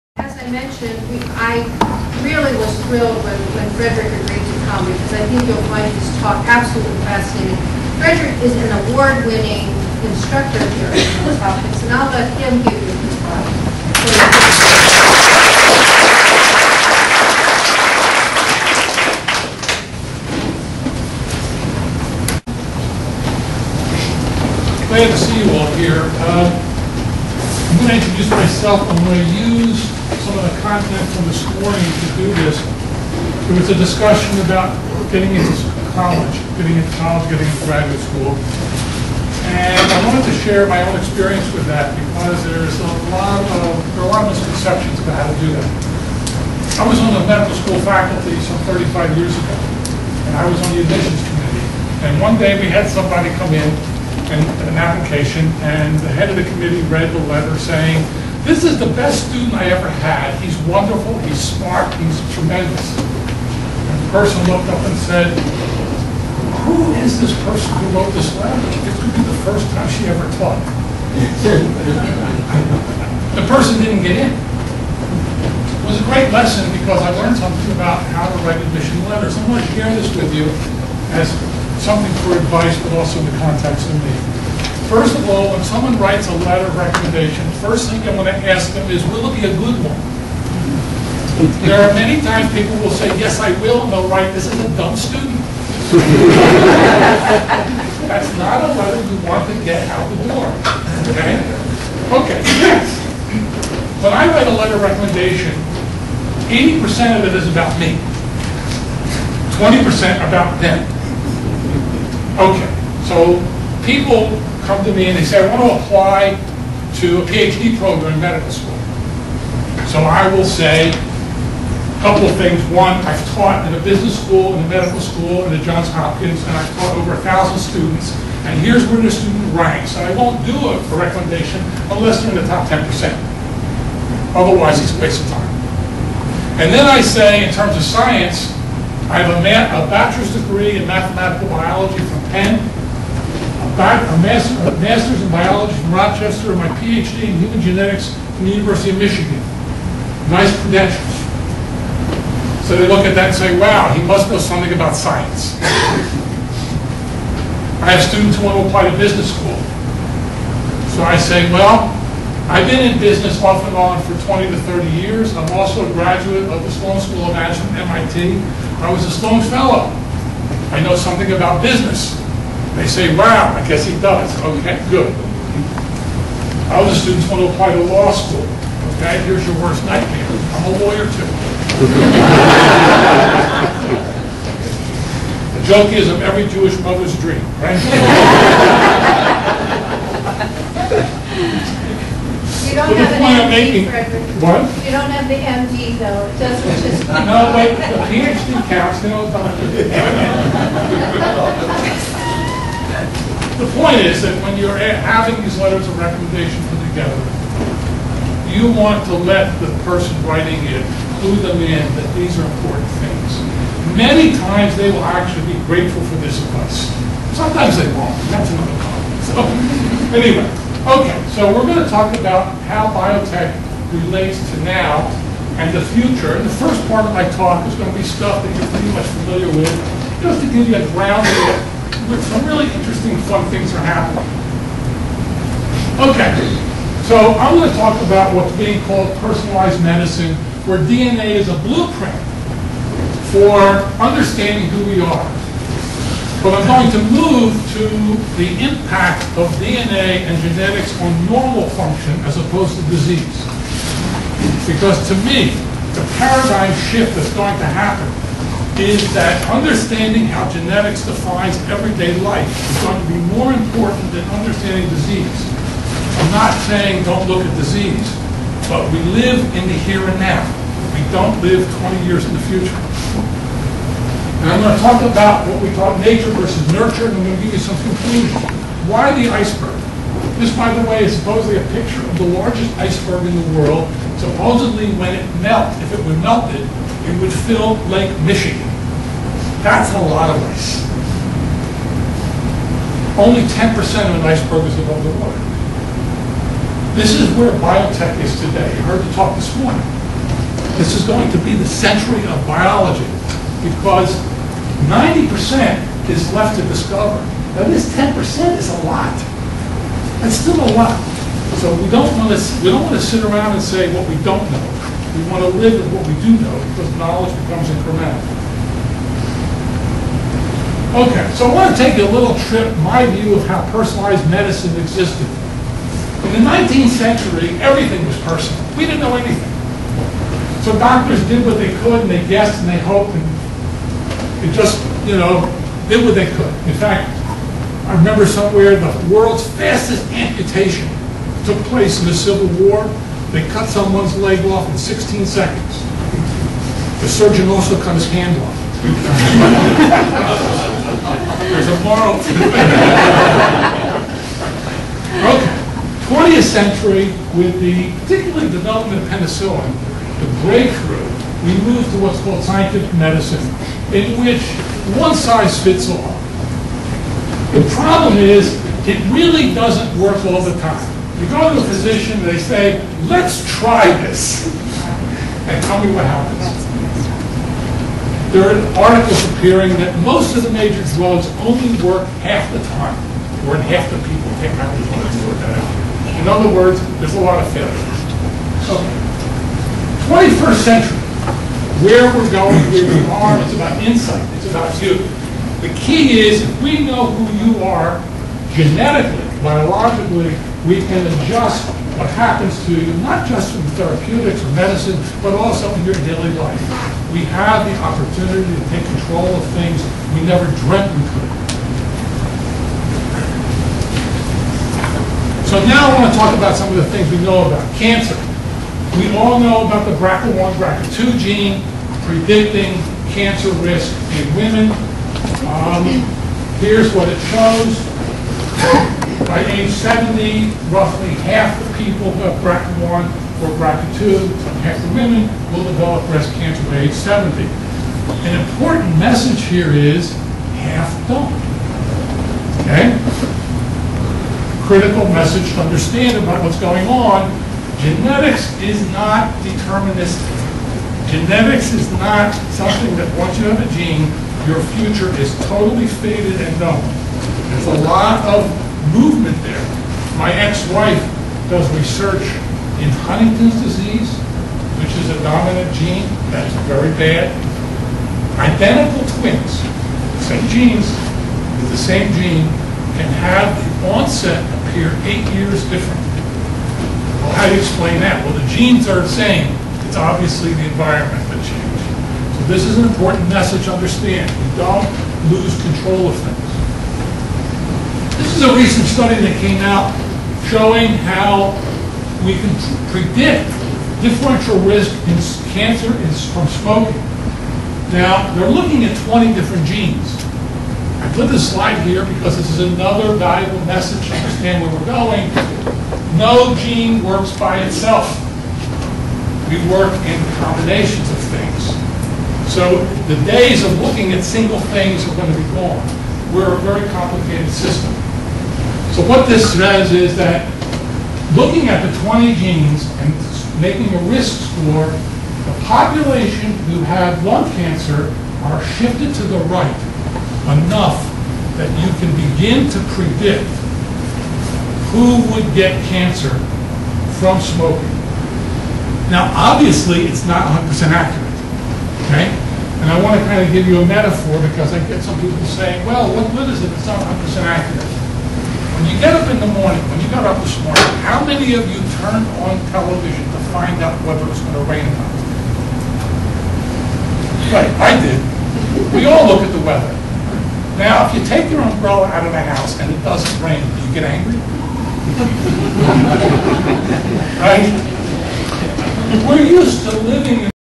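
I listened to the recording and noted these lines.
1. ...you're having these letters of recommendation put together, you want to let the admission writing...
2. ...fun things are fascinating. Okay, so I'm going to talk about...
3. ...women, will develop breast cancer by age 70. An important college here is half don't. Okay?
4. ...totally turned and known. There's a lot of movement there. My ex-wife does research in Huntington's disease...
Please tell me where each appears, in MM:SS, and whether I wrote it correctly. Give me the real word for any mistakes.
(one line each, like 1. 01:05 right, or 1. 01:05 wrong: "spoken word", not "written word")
1. 03:24 wrong: "person", not "admission"
2. 03:53 wrong: "happening", not "fascinating"
3. 07:14 wrong: "message", not "college"
4. 07:35 wrong: "faded", not "turned".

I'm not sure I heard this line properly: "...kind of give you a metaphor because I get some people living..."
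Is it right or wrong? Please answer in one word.
wrong.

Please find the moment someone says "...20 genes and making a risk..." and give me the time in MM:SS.
08:42.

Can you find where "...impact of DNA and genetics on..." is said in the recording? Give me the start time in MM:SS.
04:08.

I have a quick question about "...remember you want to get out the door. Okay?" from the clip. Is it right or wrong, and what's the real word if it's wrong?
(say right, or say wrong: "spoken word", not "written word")
wrong: "letter", not "remember".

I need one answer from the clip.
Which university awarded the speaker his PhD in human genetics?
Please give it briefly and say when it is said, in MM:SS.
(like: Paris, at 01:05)
University of Michigan, at 02:28.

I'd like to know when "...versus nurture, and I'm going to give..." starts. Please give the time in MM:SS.
04:36.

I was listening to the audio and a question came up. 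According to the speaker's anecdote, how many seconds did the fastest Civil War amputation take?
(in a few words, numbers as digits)
16.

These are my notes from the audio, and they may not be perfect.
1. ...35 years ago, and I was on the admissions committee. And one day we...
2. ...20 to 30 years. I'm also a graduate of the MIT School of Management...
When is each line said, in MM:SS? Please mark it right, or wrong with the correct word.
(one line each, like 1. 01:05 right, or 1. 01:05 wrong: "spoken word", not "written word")
1. 00:48 right
2. 02:44 wrong: "Sloan", not "MIT".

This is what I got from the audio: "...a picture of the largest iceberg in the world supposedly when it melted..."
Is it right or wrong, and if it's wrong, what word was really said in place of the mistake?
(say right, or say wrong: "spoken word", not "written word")
right.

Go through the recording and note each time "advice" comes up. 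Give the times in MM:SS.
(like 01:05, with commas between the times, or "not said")
01:22, 03:36.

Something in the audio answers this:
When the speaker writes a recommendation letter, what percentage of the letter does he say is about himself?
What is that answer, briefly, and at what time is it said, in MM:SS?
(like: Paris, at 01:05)
80%, at 01:46.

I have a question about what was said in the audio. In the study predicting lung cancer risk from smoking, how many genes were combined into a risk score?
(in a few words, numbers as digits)
20.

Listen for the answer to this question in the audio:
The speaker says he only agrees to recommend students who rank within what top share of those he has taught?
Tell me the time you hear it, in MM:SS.
02:12.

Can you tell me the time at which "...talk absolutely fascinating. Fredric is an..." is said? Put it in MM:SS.
00:06.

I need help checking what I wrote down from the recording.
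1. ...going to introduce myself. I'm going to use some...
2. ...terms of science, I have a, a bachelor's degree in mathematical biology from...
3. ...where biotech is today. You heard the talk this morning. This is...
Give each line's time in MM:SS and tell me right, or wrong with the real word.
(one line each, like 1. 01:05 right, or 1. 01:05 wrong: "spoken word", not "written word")
1. 00:27 right
2. 02:17 right
3. 04:57 right.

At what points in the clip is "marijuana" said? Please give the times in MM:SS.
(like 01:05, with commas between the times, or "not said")
06:24.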